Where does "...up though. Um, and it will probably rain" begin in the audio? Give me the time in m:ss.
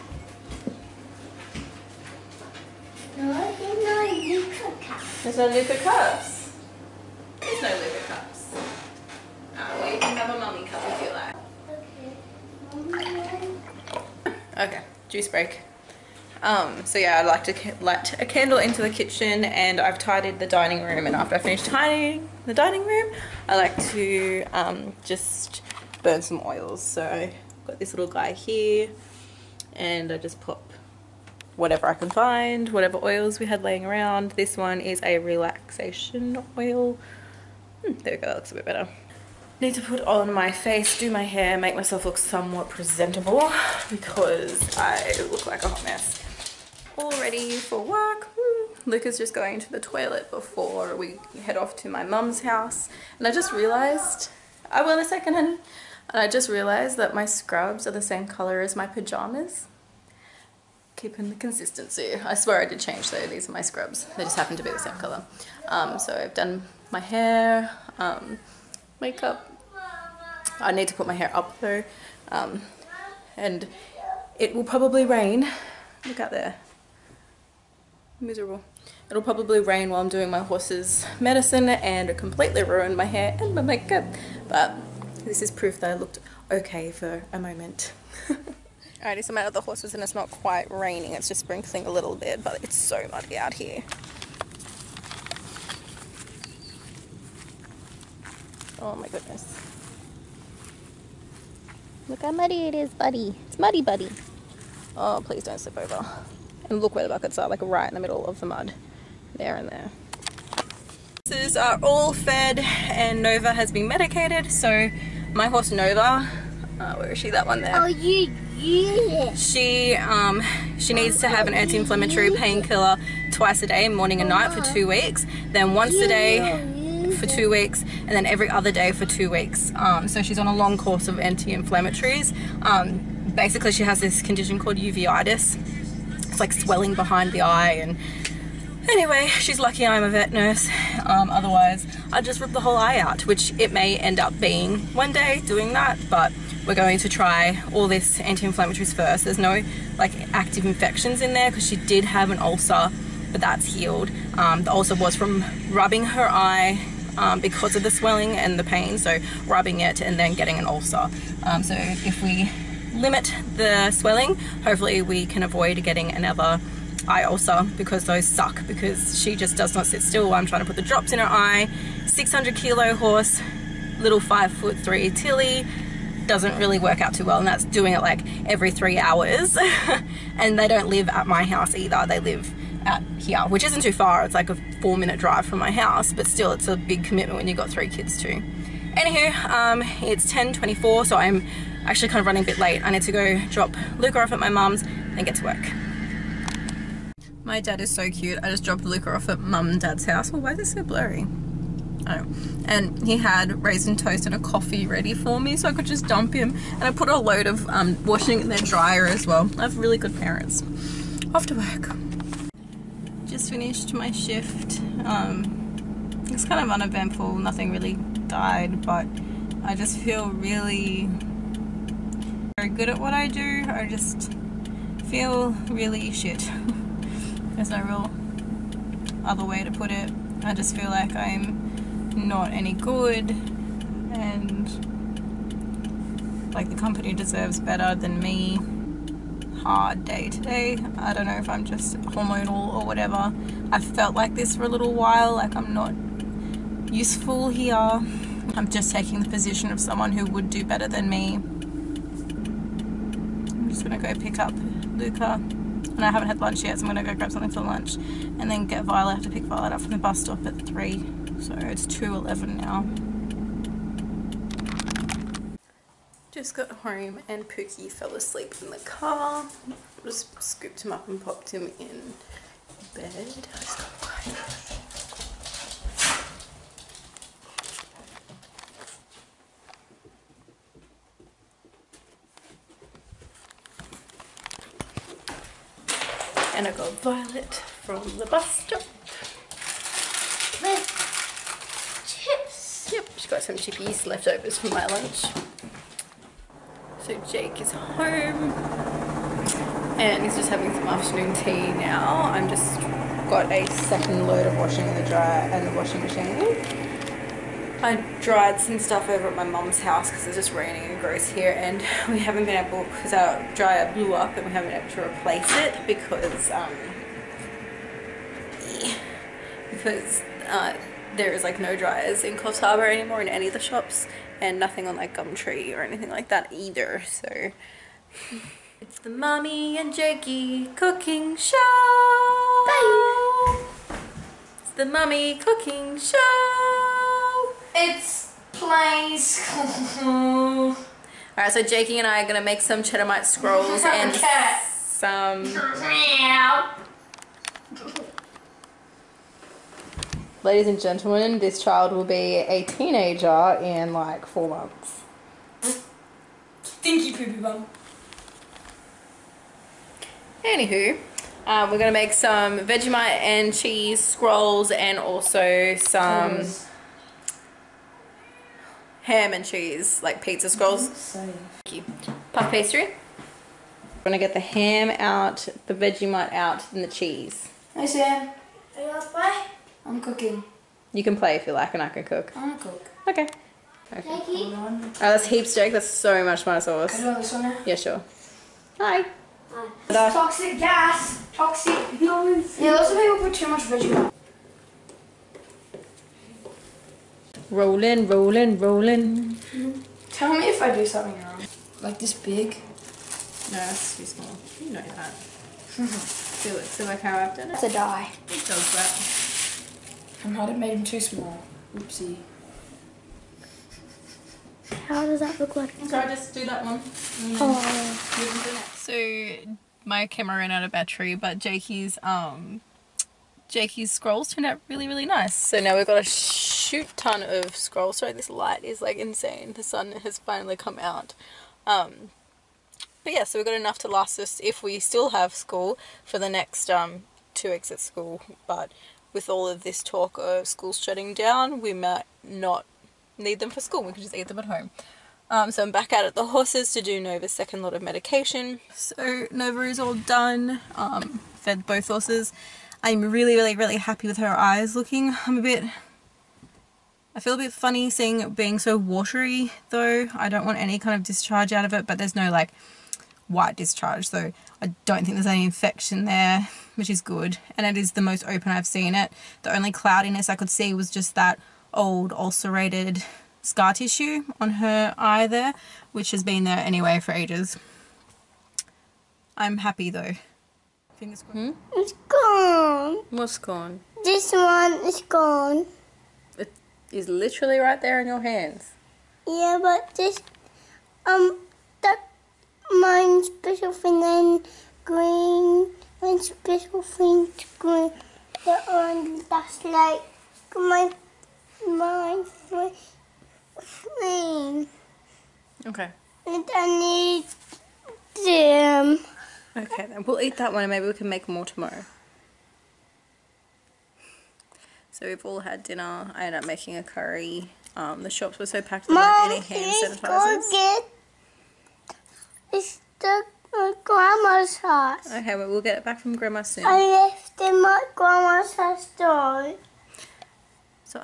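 1:11.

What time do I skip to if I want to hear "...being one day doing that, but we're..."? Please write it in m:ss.
2:24.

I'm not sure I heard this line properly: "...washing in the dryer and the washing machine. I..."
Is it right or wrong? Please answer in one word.
right.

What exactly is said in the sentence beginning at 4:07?
I'm just taking the position of someone who would do better than me.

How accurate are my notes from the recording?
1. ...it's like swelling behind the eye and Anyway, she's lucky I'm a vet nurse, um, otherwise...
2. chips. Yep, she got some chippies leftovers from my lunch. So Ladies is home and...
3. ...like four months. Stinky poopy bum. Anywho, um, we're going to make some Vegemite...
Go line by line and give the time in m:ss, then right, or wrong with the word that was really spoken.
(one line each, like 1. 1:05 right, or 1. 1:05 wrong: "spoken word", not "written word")
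1. 2:16 right
2. 4:52 wrong: "Jake", not "Ladies"
3. 5:53 right.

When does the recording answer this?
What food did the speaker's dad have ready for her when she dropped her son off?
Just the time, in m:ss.
3:23.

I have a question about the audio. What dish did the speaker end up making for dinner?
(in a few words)
Curry.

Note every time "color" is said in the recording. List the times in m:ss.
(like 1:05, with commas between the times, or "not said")
0:58, 1:04.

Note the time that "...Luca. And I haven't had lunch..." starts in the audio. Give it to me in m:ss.
4:14.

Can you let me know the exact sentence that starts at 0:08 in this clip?
Oh, well, you can have a mummy cup if you like.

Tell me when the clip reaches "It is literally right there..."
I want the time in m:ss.
8:06.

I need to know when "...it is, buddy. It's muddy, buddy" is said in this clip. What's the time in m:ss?
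1:42.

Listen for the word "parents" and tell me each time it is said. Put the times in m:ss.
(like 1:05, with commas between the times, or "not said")
3:30.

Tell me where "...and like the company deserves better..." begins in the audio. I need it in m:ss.
3:54.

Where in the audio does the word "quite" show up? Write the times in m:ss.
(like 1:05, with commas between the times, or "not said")
1:30.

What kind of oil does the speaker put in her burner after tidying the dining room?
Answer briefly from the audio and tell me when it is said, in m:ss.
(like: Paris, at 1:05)
Relaxation oil, at 0:35.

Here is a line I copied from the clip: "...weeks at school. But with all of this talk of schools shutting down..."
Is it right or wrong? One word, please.
right.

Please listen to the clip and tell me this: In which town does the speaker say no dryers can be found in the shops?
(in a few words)
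Coffs Harbour.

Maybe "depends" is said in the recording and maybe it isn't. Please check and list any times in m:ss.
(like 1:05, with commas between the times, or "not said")
not said.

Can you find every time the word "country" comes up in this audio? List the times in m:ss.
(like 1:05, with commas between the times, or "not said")
not said.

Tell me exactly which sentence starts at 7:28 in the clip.
So Nova is all done, um, fed both horses, I'm really, really, really happy with her eyes looking.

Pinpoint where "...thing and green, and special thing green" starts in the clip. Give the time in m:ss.
8:13.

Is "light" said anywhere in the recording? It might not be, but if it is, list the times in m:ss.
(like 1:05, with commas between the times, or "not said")
0:17, 7:08.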